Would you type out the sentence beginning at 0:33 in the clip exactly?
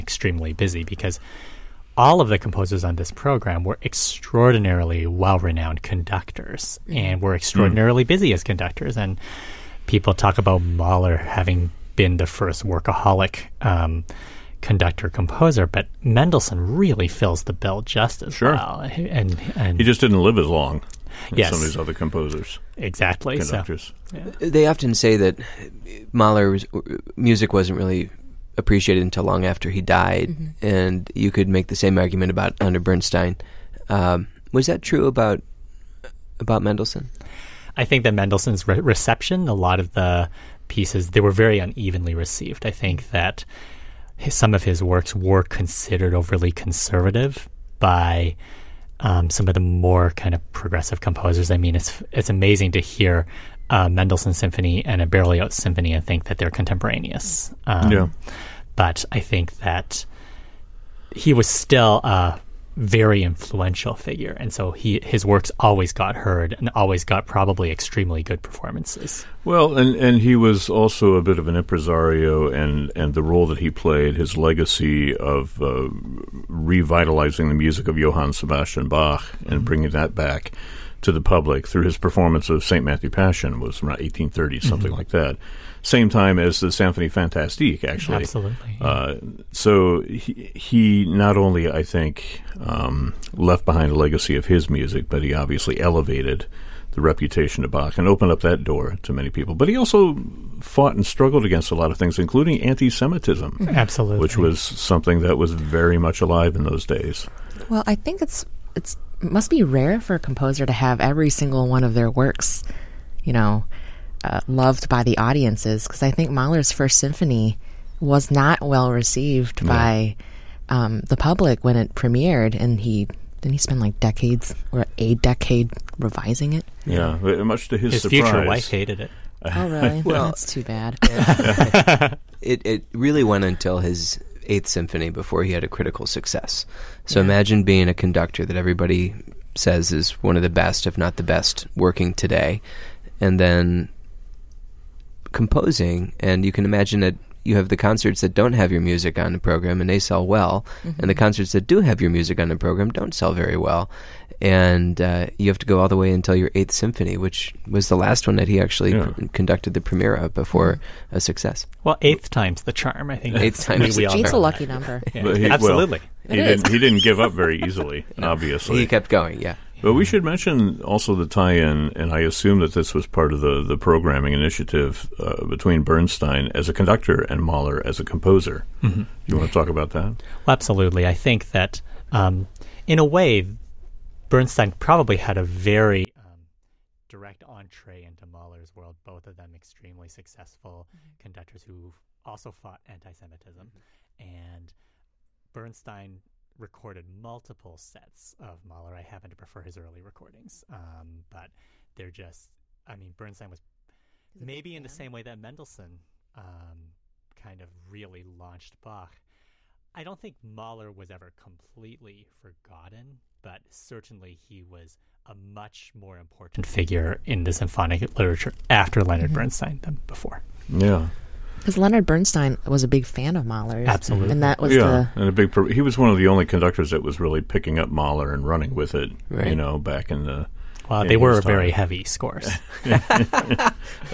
Um, was that true about about Mendelssohn?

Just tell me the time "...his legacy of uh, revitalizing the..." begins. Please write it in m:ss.
1:14.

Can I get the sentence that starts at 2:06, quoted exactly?
Yeah, much to his, his surprise.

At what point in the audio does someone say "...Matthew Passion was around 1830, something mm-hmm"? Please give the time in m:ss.
1:22.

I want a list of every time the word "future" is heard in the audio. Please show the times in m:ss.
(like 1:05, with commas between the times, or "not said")
2:08.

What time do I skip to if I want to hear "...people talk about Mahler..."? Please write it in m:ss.
0:09.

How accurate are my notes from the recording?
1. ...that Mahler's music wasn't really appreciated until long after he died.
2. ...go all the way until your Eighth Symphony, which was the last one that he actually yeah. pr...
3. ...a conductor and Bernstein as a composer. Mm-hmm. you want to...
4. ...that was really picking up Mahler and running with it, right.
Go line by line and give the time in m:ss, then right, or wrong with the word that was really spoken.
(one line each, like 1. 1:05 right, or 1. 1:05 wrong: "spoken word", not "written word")
1. 0:25 right
2. 2:35 right
3. 2:56 wrong: "Mahler", not "Bernstein"
4. 3:46 right.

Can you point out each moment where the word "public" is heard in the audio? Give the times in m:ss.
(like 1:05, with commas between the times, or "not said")
1:21, 2:01.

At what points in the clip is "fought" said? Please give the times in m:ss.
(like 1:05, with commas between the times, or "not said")
1:40, 3:12.